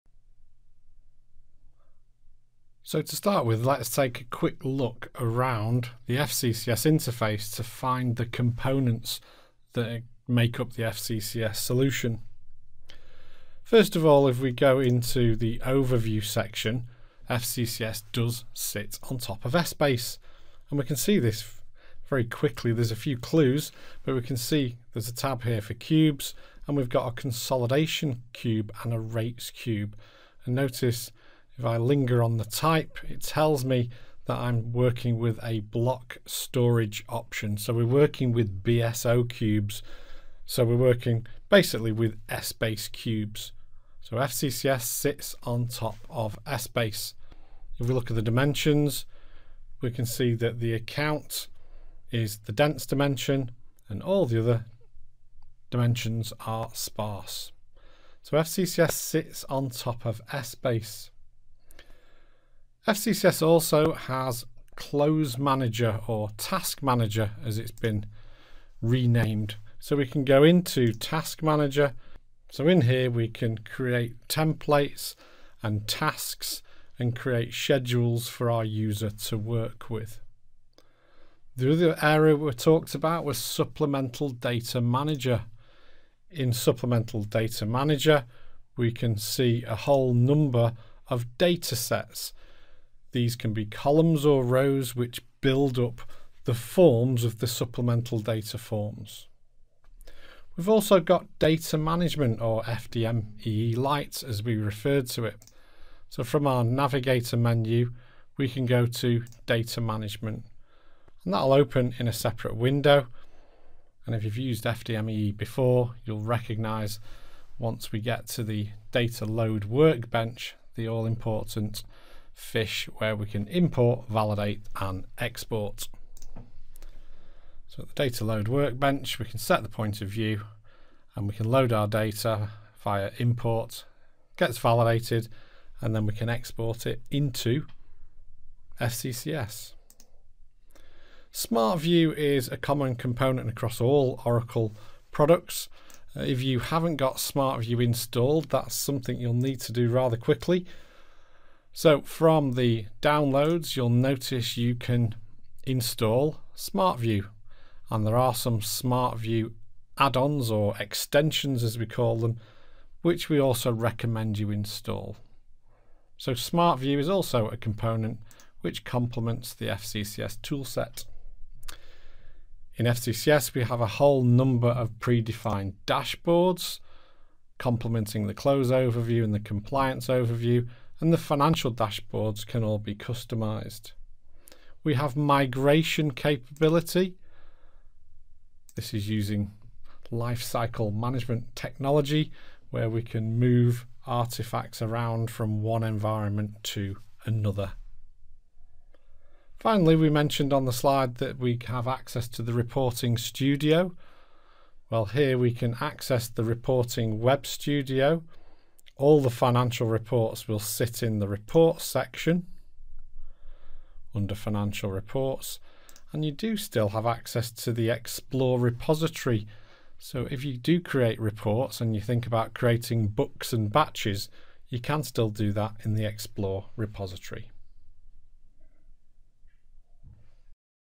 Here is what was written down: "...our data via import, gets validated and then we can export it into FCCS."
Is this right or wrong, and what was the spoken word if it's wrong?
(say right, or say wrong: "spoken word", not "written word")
right.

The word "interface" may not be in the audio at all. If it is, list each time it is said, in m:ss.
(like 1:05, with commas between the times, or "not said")
0:06.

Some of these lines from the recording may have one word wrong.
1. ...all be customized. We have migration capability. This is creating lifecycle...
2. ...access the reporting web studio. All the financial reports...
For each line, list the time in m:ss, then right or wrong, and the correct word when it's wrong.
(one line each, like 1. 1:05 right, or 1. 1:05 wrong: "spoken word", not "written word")
1. 3:02 wrong: "using", not "creating"
2. 3:25 right.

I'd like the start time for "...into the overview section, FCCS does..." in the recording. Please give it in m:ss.
0:14.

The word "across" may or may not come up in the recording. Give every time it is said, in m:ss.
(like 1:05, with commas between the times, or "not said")
2:23.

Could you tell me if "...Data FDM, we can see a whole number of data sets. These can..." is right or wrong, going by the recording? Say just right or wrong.
wrong.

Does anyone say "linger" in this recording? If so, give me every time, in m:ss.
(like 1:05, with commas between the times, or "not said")
0:31.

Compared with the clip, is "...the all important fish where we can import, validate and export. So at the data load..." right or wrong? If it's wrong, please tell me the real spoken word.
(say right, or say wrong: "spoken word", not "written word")
right.